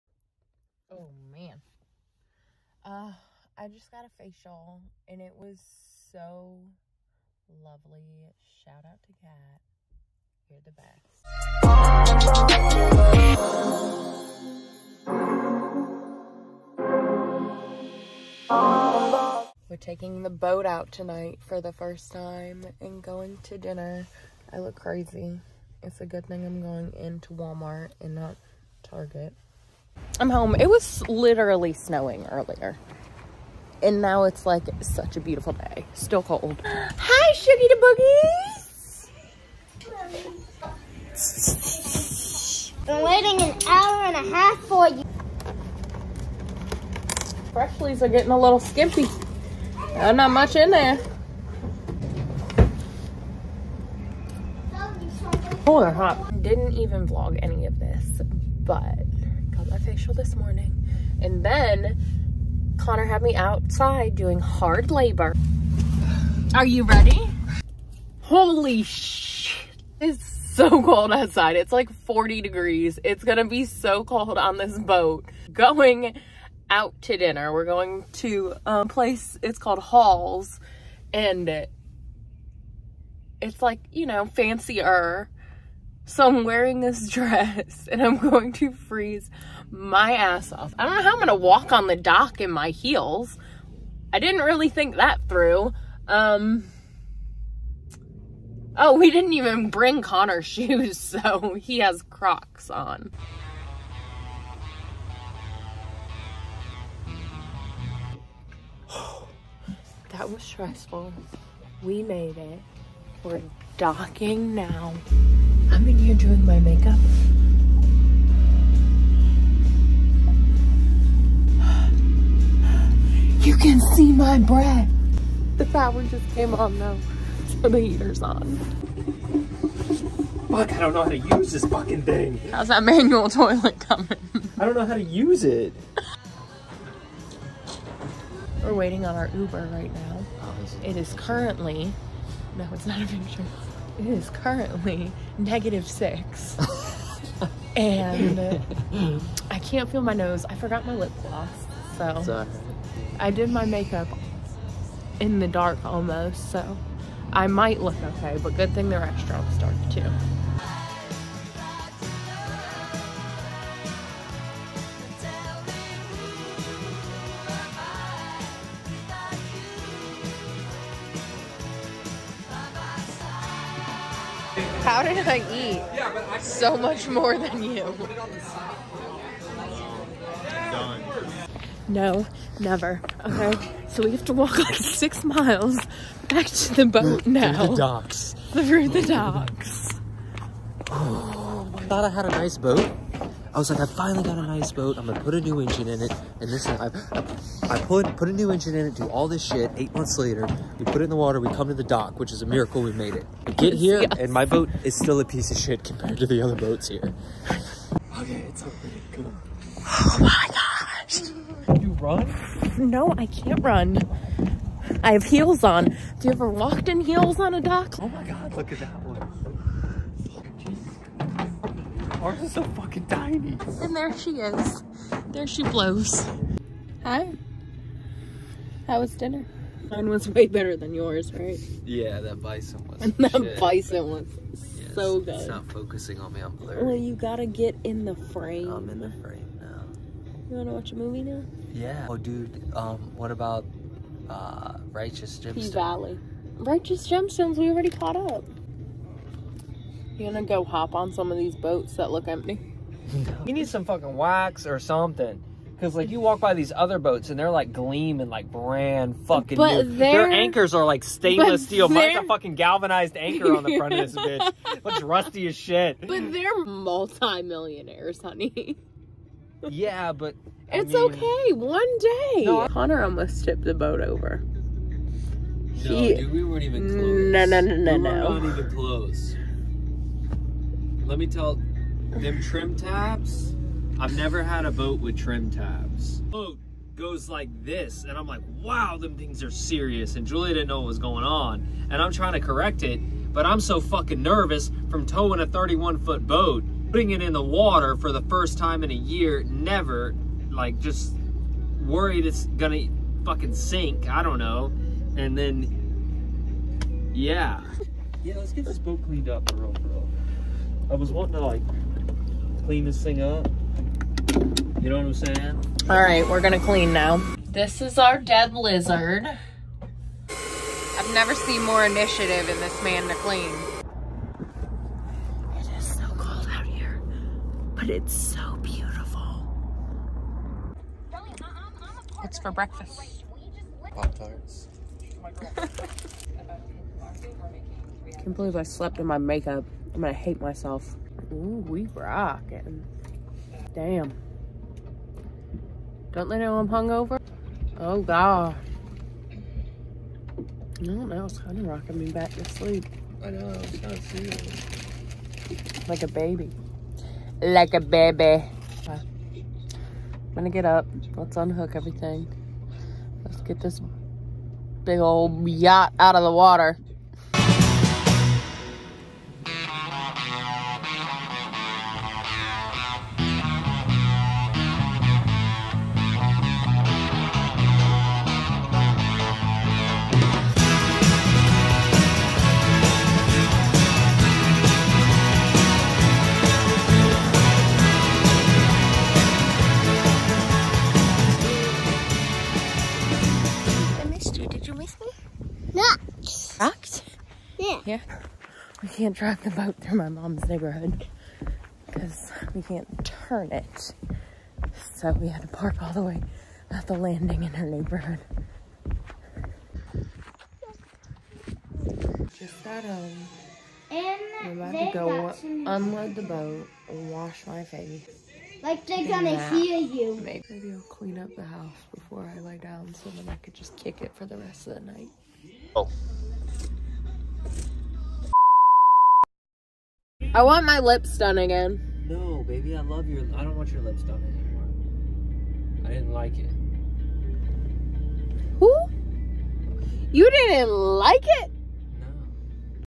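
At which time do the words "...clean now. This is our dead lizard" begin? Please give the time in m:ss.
5:16.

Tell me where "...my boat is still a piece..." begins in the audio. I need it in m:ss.
3:24.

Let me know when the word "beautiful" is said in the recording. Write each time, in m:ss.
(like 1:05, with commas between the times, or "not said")
0:35, 5:28.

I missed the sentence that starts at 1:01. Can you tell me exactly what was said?
And then Connor had me outside doing hard labor.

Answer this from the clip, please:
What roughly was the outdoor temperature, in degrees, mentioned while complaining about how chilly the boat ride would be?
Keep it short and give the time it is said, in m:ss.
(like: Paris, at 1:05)
40, at 1:12.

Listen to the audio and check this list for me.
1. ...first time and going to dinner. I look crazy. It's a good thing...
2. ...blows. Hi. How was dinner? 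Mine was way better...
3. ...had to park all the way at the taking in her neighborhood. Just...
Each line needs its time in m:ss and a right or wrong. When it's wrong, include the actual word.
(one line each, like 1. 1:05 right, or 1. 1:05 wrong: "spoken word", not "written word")
1. 0:21 right
2. 3:45 right
3. 6:45 wrong: "landing", not "taking".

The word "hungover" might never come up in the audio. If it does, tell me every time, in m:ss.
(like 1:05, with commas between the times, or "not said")
5:46.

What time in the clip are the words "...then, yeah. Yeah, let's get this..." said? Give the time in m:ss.
5:05.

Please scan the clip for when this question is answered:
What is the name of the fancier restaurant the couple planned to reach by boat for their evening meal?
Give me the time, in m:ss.
1:19.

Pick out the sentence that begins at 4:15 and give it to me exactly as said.
Because, like, you walk by these other boats and they're, like, gleaming, like, brand fucking but new.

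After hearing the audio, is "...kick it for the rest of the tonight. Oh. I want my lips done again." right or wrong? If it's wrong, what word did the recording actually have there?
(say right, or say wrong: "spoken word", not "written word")
wrong: "night", not "tonight".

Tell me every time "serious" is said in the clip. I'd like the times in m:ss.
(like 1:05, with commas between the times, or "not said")
4:49, 5:54.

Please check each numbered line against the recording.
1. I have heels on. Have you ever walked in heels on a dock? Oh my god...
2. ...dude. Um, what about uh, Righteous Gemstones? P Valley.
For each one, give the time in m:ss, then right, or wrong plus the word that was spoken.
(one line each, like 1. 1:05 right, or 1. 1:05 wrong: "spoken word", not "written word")
1. 3:35 right
2. 4:02 right.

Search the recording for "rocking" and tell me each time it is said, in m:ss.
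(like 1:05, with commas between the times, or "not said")
5:41, 5:51.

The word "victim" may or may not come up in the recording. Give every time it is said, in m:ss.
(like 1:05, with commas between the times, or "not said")
not said.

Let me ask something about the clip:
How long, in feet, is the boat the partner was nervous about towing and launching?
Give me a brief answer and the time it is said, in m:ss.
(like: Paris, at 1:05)
31, at 4:55.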